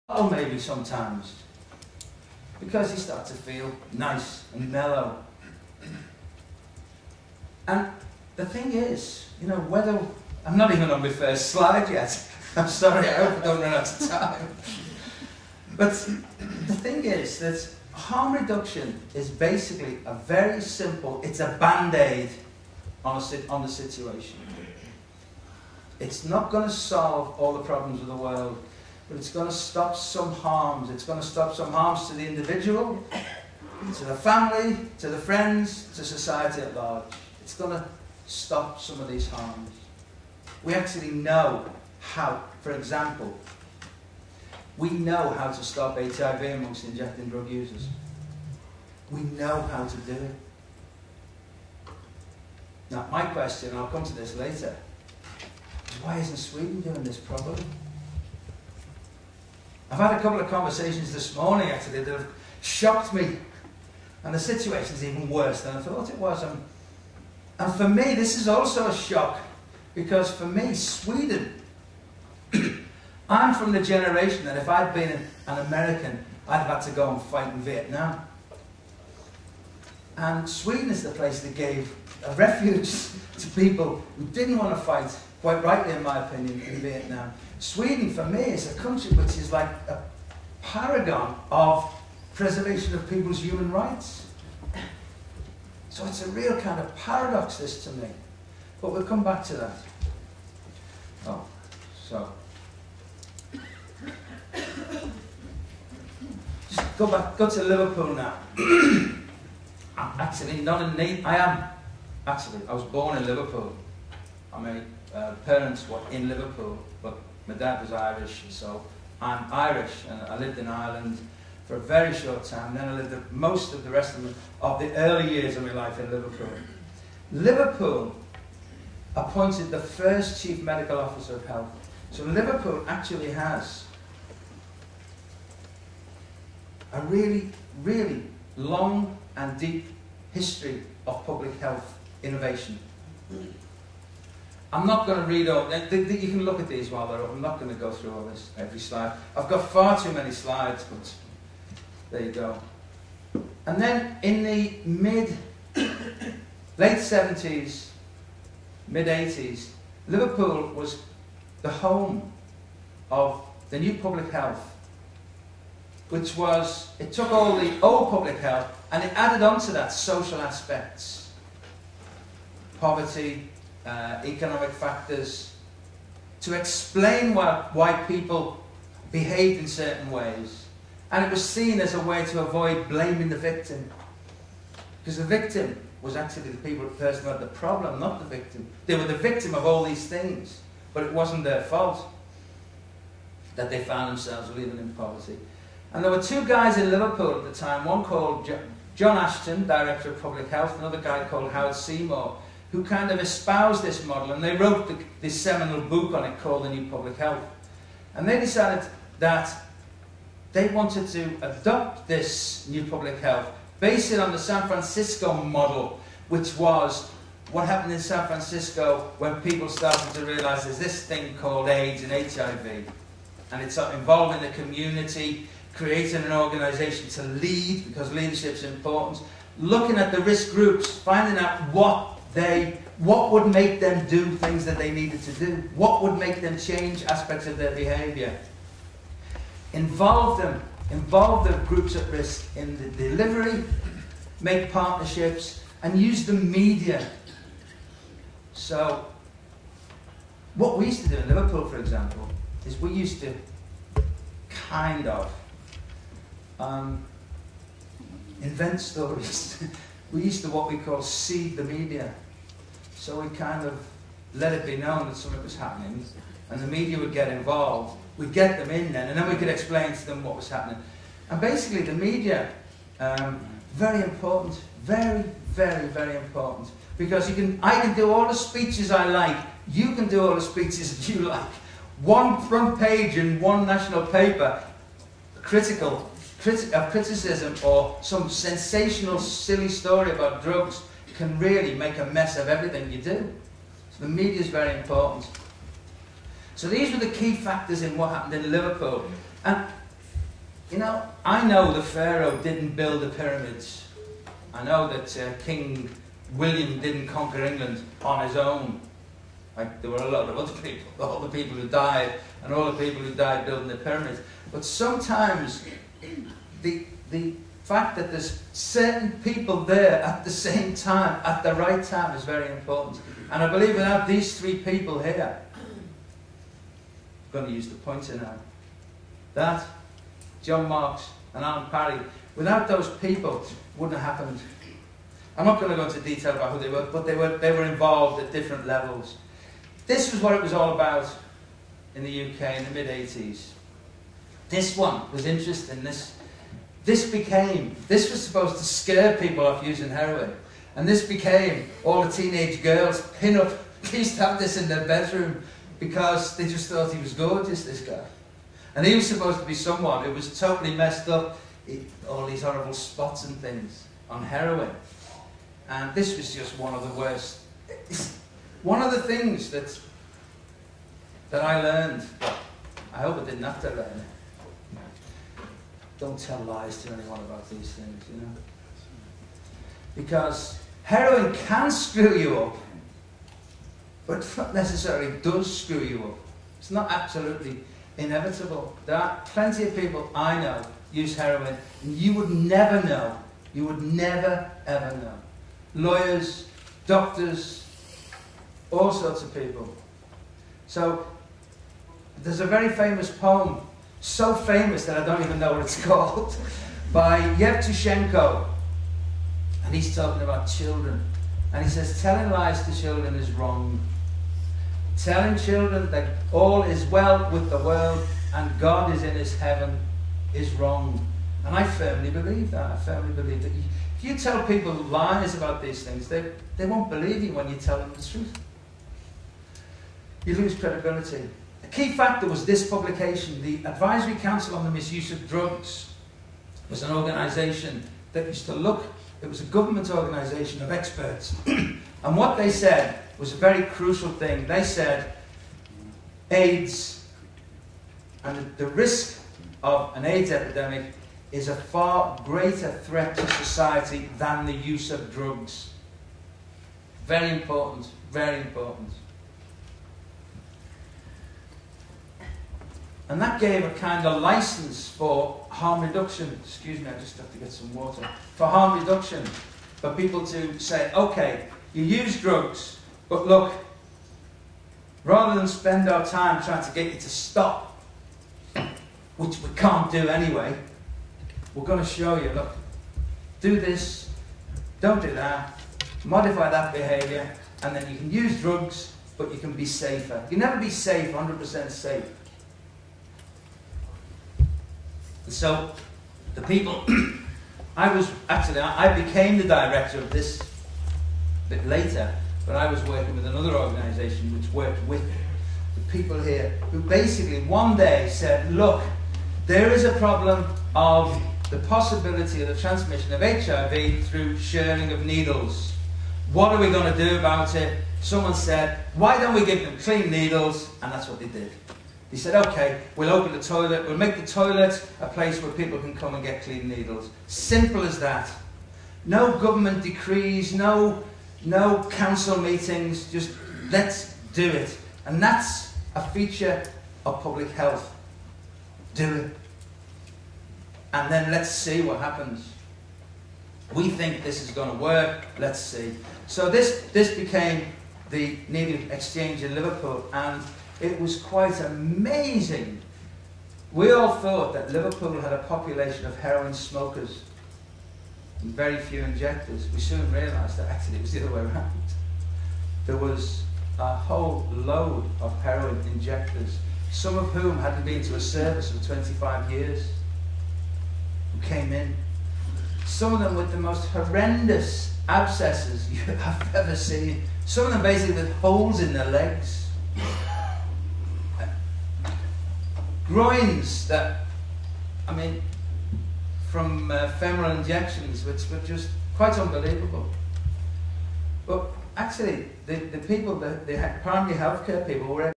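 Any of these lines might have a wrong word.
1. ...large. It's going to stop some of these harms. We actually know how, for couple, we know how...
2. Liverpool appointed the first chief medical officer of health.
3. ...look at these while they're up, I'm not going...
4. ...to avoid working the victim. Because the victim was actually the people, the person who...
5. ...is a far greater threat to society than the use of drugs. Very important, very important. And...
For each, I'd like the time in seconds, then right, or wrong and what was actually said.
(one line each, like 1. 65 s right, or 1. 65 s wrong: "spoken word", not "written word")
1. 36 s wrong: "example", not "couple"
2. 127 s right
3. 146 s right
4. 182 s wrong: "blaming", not "working"
5. 451 s right.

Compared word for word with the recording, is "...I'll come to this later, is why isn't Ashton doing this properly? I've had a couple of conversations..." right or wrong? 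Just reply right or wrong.
wrong.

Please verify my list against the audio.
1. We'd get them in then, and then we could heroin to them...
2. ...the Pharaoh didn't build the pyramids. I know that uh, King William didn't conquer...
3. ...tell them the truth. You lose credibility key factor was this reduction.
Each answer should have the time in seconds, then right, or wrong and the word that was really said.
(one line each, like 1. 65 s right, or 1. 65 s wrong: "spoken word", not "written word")
1. 268 s wrong: "explain", not "heroin"
2. 301 s right
3. 427 s wrong: "publication", not "reduction".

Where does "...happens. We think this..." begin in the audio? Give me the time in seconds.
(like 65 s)
541 s.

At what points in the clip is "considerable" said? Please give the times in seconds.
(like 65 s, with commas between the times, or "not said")
not said.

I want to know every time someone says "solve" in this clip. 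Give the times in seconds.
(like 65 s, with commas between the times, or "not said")
26 s.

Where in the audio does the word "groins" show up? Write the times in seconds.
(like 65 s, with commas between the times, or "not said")
583 s.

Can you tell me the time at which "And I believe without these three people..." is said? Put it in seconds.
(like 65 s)
323 s.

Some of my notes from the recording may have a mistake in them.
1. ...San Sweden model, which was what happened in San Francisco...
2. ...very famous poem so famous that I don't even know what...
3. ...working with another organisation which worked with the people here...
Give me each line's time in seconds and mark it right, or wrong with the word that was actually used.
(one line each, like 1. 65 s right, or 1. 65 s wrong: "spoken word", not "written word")
1. 214 s wrong: "Francisco", not "Sweden"
2. 402 s right
3. 502 s right.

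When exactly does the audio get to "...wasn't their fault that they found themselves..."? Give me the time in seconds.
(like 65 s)
191 s.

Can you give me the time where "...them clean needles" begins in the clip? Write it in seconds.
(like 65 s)
519 s.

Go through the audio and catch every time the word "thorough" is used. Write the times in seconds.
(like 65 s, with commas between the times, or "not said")
not said.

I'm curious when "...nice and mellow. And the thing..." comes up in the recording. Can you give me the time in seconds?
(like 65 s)
3 s.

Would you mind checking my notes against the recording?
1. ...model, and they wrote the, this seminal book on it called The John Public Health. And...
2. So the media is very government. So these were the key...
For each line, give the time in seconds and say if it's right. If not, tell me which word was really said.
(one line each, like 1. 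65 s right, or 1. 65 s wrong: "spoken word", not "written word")
1. 204 s wrong: "New", not "John"
2. 293 s wrong: "important", not "government".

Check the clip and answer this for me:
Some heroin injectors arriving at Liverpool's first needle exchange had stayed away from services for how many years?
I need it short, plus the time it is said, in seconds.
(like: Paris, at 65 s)
25, at 568 s.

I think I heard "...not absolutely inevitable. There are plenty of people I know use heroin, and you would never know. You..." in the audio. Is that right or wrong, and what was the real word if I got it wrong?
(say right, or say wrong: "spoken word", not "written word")
right.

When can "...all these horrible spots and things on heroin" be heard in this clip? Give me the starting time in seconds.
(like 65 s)
362 s.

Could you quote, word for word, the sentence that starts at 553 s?
We all thought that Liverpool had a population of heroin smokers and very few injectors.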